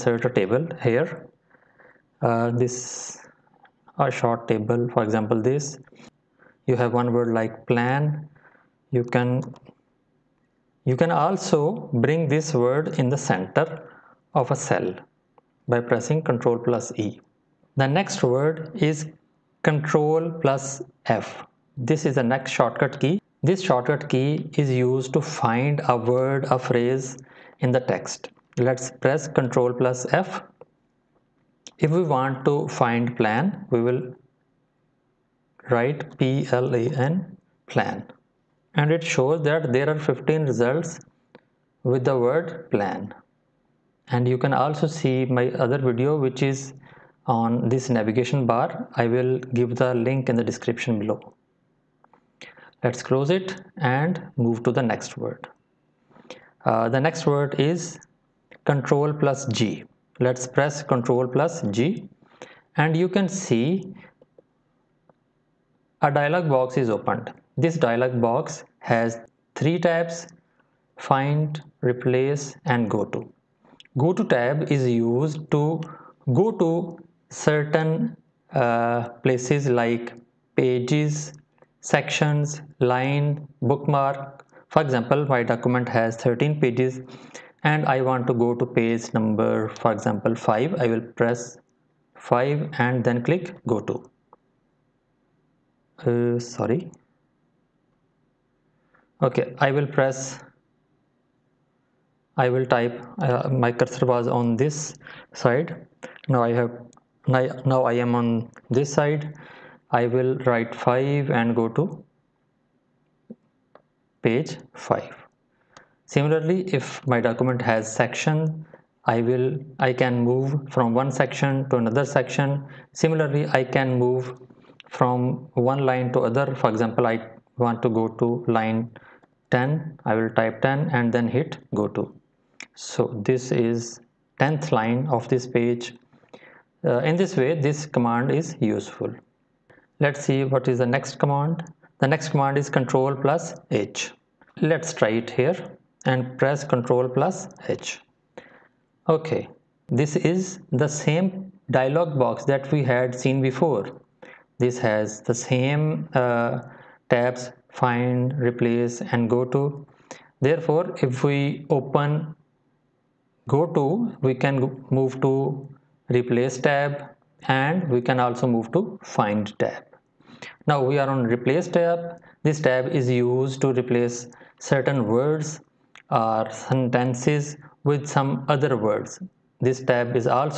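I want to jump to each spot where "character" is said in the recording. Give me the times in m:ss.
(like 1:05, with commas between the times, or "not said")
not said.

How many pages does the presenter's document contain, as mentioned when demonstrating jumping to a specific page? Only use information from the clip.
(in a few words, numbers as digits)
13.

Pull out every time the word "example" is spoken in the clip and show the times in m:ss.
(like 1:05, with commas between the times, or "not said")
0:05, 1:24, 1:29, 2:06.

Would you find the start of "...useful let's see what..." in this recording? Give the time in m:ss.
2:18.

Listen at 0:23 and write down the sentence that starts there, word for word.
This shortcut key is used to find a word, a phrase in the text.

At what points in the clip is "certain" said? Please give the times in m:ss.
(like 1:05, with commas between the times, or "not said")
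1:17, 2:54.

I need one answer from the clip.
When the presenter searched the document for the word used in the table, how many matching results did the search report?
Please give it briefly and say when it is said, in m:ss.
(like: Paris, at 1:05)
15, at 0:39.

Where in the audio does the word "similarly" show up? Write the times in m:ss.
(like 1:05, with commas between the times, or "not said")
1:56, 2:02.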